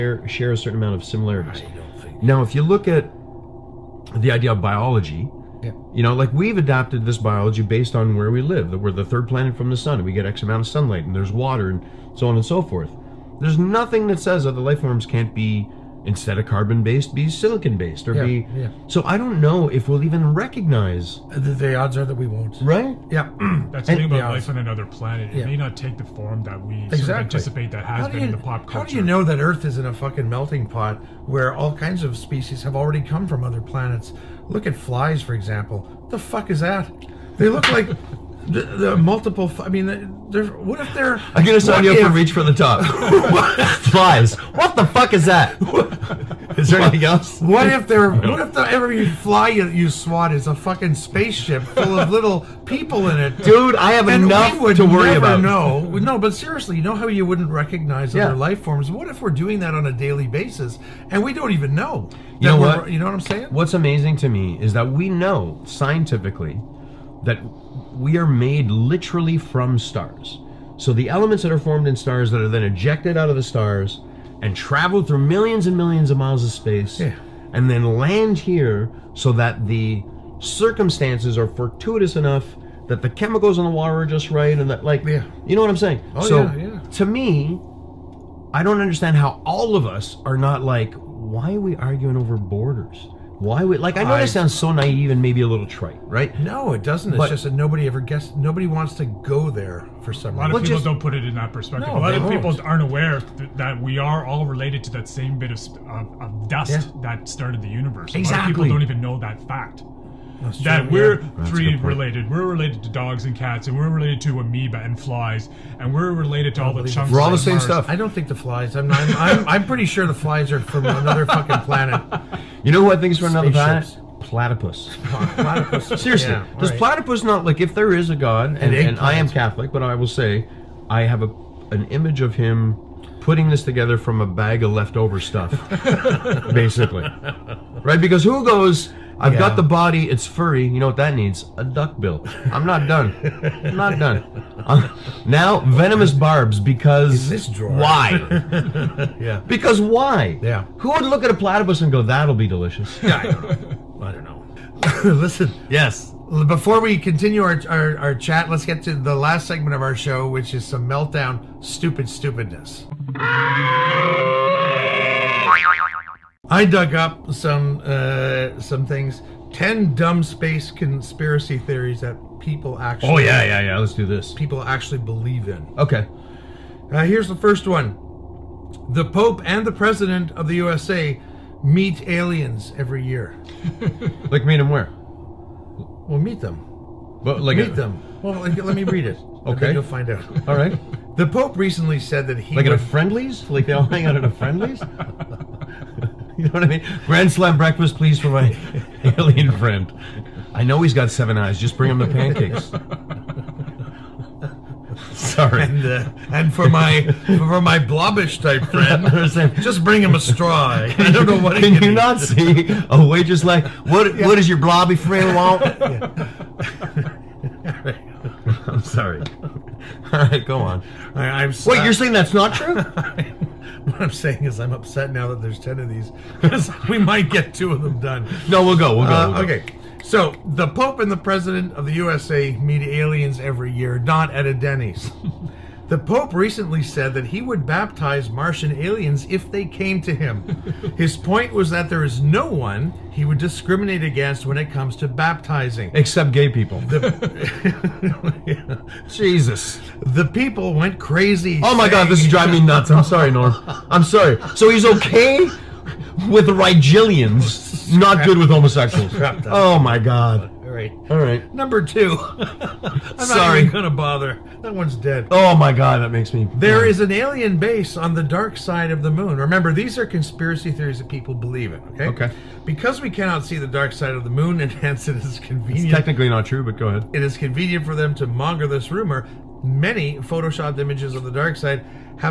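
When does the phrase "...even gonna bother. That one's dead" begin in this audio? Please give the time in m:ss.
4:23.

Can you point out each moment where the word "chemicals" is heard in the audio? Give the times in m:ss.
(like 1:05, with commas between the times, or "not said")
1:23.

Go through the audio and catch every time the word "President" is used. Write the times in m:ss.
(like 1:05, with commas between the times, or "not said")
2:59, 3:51.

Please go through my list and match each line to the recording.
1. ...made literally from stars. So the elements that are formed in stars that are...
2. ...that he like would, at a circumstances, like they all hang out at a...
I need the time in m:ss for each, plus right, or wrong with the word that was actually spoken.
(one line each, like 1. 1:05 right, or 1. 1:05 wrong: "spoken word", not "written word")
1. 1:08 right
2. 3:12 wrong: "friendlies", not "circumstances".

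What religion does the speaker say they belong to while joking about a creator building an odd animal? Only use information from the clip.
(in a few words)
Catholic.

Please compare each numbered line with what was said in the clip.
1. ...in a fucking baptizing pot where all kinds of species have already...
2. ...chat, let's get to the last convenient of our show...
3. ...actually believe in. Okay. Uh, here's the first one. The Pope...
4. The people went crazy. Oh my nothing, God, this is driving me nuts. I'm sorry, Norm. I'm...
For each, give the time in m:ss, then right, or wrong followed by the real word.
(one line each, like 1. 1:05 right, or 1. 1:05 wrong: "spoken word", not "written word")
1. 0:29 wrong: "melting", not "baptizing"
2. 2:38 wrong: "segment", not "convenient"
3. 2:54 right
4. 4:10 wrong: "saying", not "nothing".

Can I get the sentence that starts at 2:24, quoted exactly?
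I'm, now venomous barbs because In this drawer.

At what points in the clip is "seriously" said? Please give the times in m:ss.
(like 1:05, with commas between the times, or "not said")
0:56, 2:05.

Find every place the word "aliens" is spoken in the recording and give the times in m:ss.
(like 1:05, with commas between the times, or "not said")
3:02, 3:19, 3:52, 3:58, 4:27.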